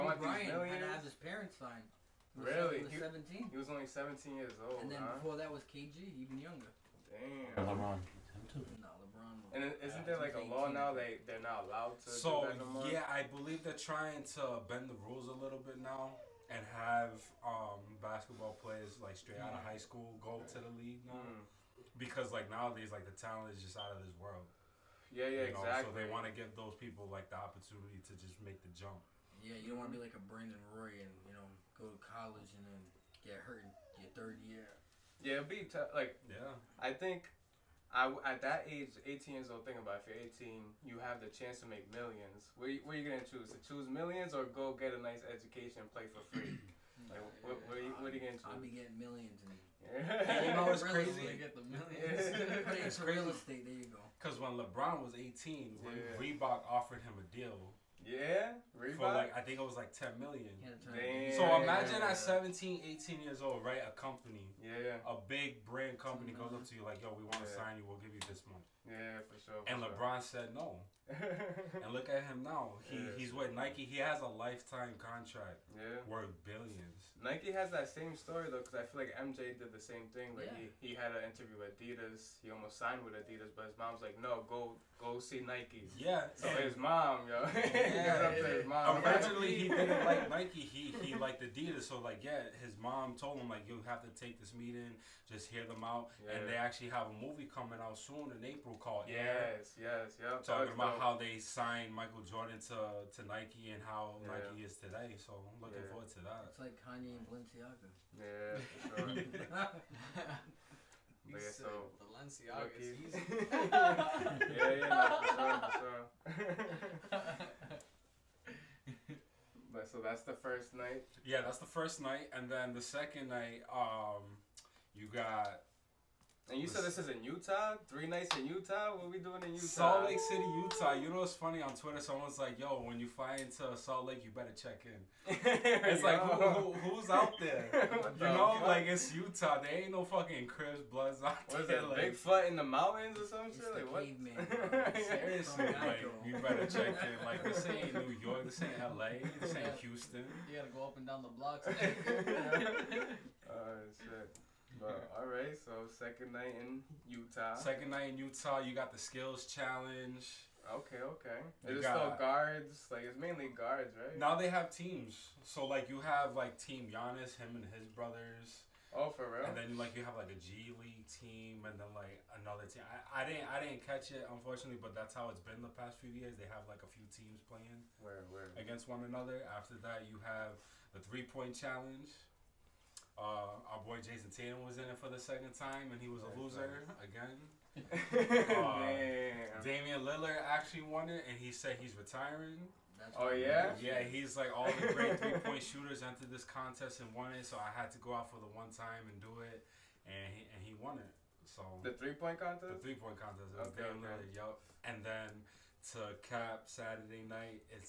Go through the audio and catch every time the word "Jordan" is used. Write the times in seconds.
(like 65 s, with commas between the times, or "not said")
102 s.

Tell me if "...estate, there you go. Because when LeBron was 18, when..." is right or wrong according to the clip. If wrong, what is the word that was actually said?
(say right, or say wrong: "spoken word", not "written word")
right.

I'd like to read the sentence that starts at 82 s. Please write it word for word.
He almost signed with Adidas, but his mom's like, no, go go see Nikes.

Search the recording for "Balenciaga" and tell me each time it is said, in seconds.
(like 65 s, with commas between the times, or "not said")
107 s, 112 s.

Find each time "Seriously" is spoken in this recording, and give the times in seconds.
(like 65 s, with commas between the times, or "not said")
145 s.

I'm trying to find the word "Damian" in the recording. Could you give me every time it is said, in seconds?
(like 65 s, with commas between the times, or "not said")
189 s, 203 s.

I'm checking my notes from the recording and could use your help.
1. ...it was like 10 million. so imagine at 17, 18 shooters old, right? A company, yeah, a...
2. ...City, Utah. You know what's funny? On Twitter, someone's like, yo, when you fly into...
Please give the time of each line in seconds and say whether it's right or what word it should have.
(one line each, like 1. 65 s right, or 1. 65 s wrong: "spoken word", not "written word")
1. 59 s wrong: "years", not "shooters"
2. 130 s right.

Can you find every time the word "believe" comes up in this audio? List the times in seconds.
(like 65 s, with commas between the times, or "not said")
13 s.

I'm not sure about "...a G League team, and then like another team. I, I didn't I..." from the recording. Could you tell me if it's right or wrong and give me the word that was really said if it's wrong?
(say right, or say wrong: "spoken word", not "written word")
right.